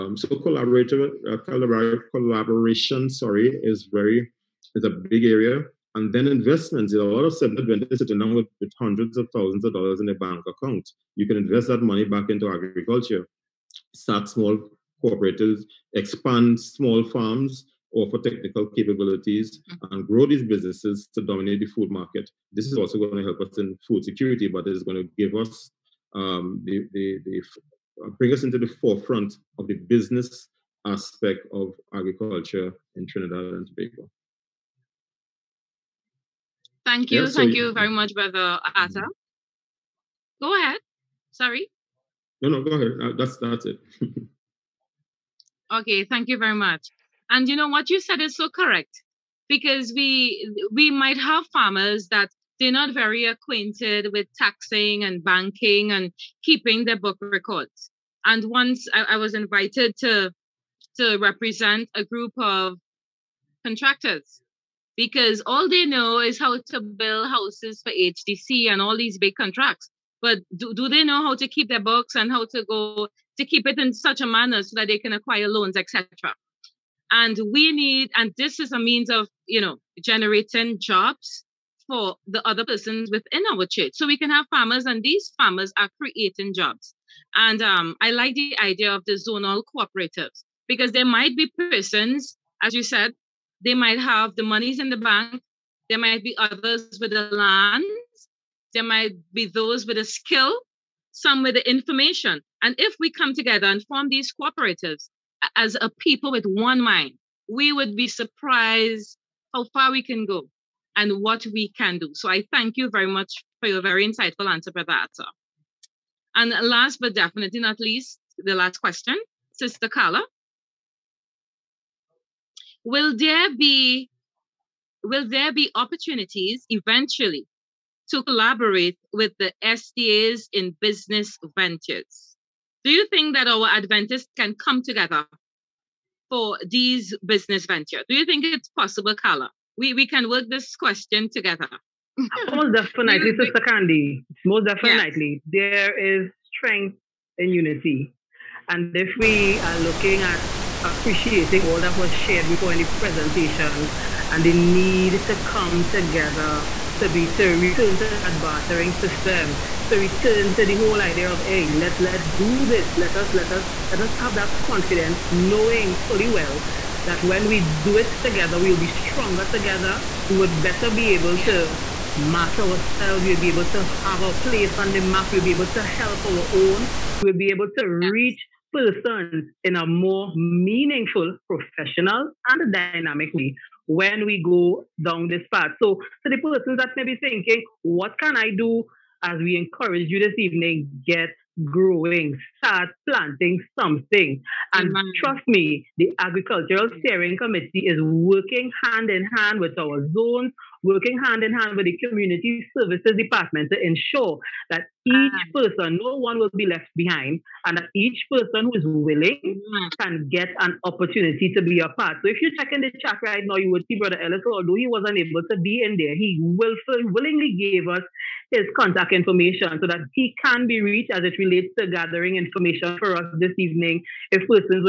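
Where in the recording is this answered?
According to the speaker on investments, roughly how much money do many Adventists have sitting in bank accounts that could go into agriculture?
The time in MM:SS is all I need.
00:08.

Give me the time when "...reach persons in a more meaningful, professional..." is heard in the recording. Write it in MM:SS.
02:57.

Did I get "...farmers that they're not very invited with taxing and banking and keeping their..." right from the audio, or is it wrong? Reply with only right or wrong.
wrong.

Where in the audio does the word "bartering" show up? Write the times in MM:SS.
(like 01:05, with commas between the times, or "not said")
02:38.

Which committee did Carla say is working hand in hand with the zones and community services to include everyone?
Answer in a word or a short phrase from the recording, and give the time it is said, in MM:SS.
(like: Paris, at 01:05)
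Agricultural Steering Committee, at 03:16.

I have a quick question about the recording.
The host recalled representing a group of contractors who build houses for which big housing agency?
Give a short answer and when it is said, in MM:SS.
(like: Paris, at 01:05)
HDC, at 01:07.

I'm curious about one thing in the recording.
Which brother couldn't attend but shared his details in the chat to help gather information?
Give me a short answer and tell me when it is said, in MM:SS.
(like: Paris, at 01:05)
Brother Ellis, at 03:33.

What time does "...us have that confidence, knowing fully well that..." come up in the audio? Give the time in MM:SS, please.
02:44.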